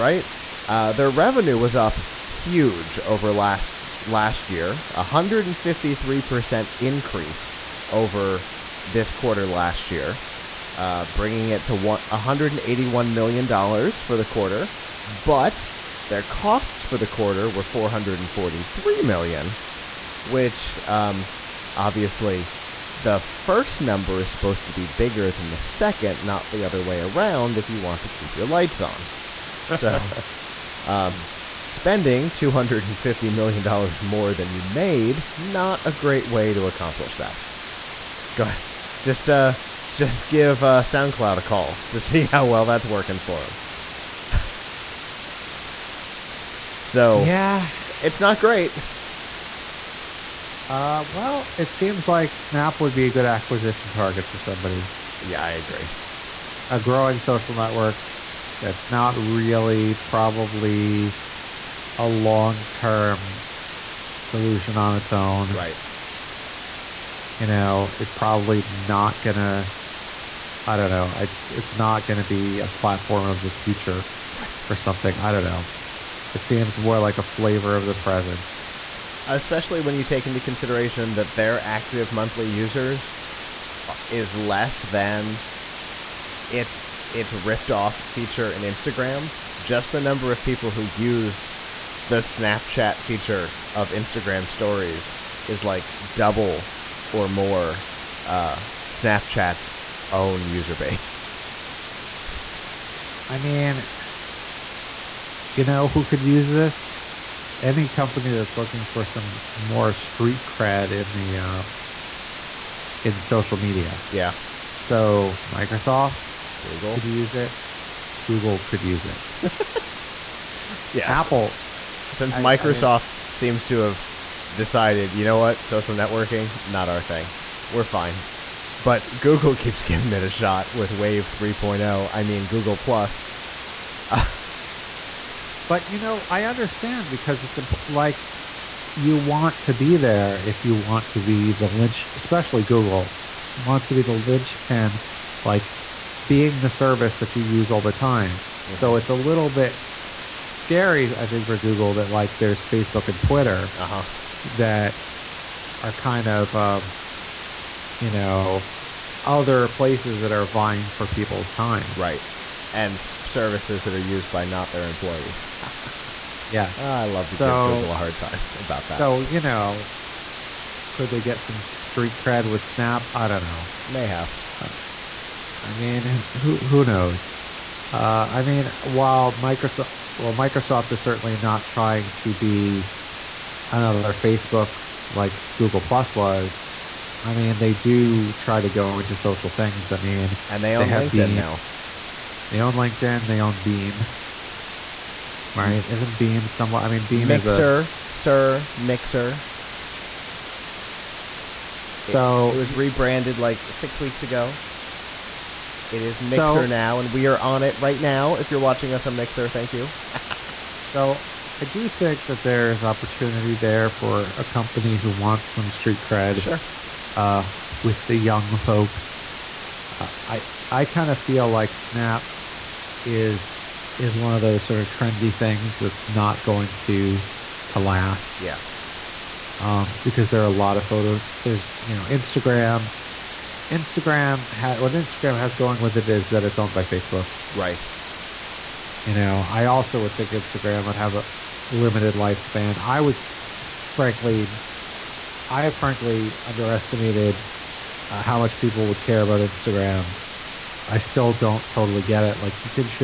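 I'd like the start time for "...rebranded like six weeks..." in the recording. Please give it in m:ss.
3:22.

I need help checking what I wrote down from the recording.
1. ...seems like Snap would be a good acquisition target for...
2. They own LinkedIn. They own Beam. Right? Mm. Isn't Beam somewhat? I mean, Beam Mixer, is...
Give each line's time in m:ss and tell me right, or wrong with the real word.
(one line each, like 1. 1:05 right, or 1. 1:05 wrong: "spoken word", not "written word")
1. 0:51 right
2. 3:12 right.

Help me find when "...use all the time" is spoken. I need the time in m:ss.
2:27.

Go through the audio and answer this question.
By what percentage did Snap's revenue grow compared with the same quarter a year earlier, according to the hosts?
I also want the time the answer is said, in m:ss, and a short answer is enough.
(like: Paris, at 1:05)
153%, at 0:04.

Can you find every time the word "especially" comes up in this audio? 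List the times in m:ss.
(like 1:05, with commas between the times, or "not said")
1:19, 2:22.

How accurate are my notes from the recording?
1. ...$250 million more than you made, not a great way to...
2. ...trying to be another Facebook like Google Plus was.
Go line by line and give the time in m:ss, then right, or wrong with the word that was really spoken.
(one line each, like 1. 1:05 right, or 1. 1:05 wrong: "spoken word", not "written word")
1. 0:32 right
2. 3:01 right.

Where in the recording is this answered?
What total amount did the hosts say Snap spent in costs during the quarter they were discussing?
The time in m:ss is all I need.
0:17.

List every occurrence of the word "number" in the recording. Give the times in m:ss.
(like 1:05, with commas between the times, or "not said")
0:23, 1:30.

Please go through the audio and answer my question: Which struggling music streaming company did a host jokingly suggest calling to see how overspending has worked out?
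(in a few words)
SoundCloud.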